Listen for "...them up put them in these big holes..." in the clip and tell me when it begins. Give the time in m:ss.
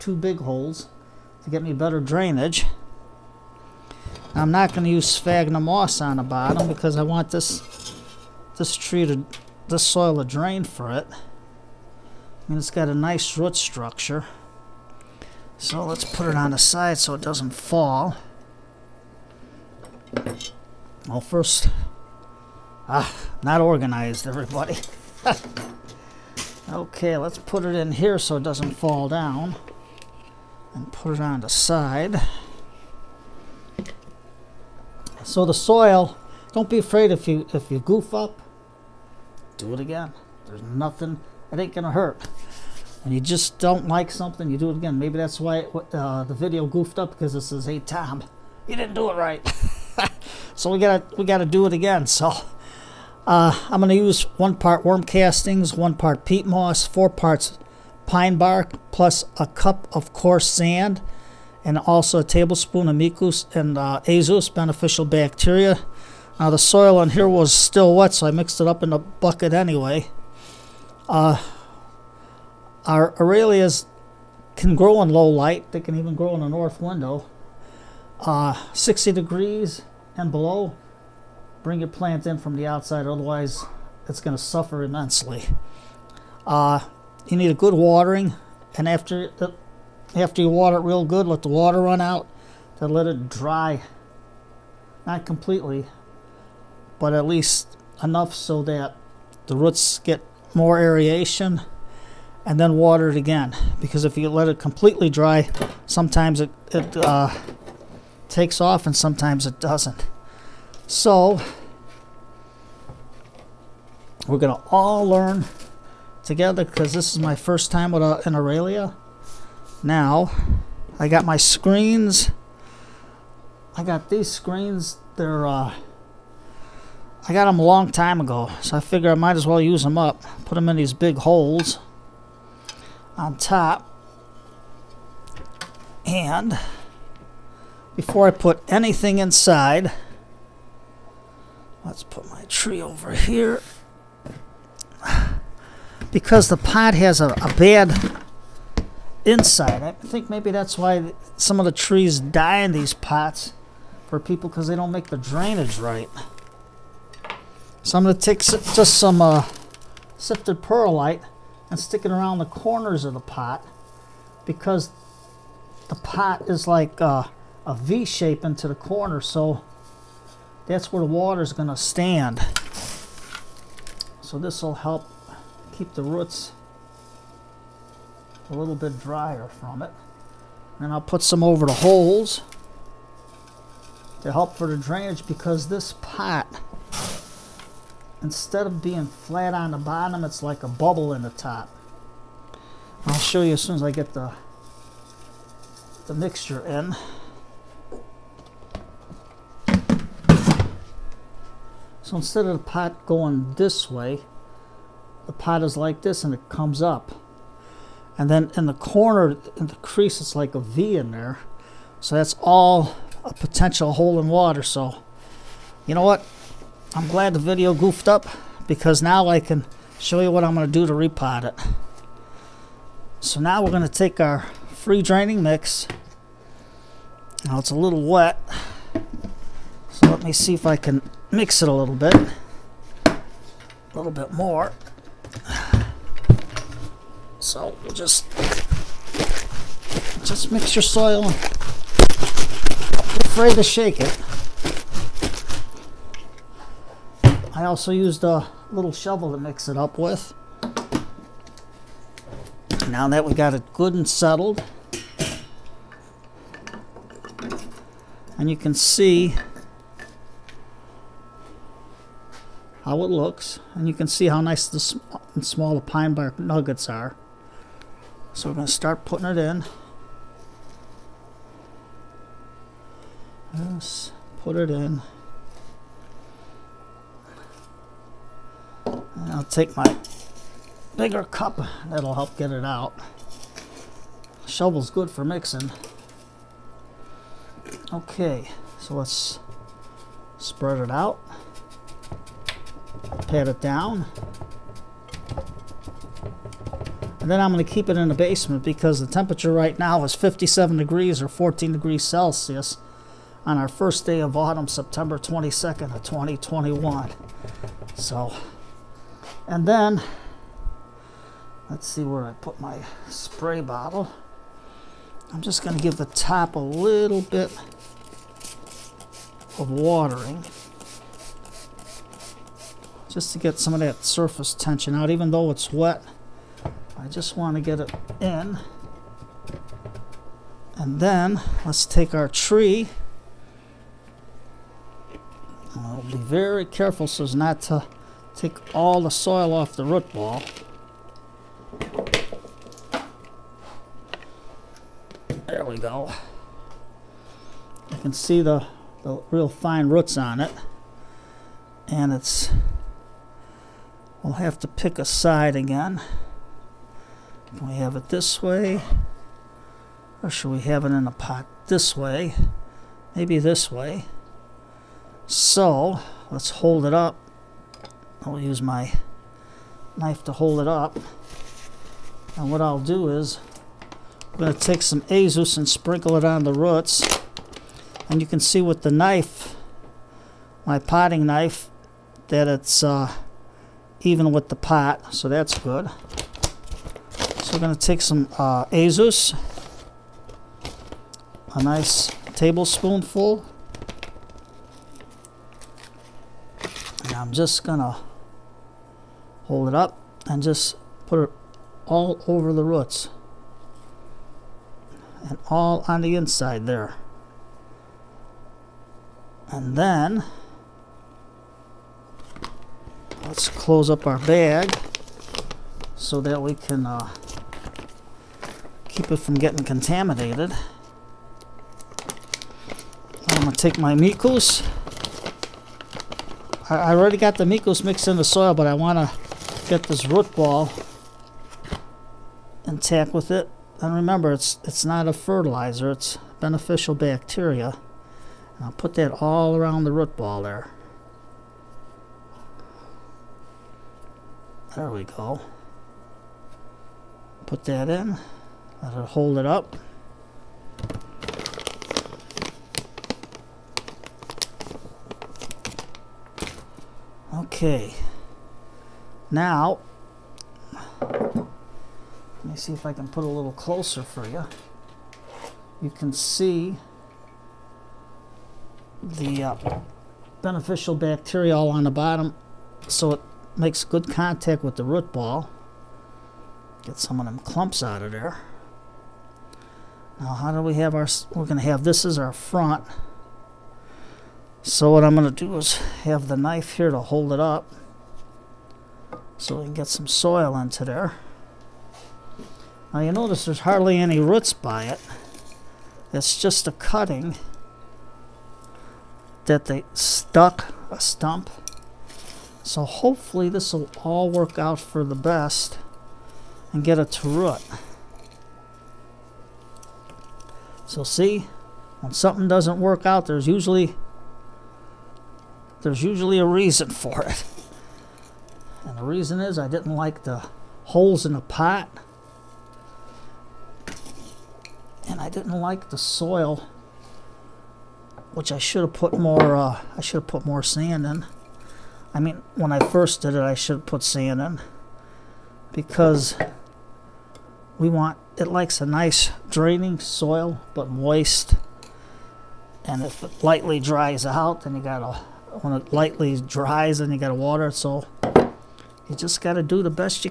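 2:09.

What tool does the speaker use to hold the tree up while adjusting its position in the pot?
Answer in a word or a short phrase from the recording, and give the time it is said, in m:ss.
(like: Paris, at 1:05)
potting knife, at 6:20.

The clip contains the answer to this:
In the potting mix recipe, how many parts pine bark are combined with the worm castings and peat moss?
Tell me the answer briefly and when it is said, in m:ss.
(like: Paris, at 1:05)
4 parts, at 0:56.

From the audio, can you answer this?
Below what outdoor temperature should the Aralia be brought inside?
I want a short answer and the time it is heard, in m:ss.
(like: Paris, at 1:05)
60 degrees, at 1:18.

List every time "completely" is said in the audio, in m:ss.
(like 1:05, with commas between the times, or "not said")
1:35, 1:44.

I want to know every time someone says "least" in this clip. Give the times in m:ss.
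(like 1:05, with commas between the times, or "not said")
1:37.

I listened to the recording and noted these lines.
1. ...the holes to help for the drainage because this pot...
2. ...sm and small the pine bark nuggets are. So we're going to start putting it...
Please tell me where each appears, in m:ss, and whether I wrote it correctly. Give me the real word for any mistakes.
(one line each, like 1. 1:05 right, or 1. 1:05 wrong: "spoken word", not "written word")
1. 3:01 right
2. 4:24 right.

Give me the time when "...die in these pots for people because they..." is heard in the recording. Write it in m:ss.
2:32.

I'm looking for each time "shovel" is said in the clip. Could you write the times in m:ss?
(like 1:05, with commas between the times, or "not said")
4:08, 4:44.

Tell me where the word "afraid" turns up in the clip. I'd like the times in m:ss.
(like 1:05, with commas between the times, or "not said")
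0:36, 4:03.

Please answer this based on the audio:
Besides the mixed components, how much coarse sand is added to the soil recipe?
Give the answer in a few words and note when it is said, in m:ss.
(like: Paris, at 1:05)
a cup, at 0:59.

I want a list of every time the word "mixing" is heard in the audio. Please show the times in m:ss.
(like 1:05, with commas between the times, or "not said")
4:45.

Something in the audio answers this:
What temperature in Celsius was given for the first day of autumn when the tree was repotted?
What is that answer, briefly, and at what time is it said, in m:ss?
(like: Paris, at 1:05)
14 degrees, at 5:01.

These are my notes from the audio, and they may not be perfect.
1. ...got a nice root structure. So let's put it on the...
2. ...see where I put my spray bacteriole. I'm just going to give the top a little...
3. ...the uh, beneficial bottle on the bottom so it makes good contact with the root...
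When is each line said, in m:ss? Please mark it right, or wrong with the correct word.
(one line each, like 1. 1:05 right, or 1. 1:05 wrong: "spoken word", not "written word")
1. 0:12 right
2. 5:11 wrong: "bottle", not "bacteriole"
3. 7:49 wrong: "bacteriole", not "bottle".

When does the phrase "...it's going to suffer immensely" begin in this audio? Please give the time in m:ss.
1:24.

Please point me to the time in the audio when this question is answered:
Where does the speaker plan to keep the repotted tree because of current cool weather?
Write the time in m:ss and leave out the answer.
4:58.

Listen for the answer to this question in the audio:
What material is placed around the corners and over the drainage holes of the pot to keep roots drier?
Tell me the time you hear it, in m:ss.
2:40.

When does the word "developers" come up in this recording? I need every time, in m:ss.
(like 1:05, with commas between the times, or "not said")
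not said.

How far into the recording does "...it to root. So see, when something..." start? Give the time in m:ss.
8:26.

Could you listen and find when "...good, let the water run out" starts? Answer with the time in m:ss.
1:31.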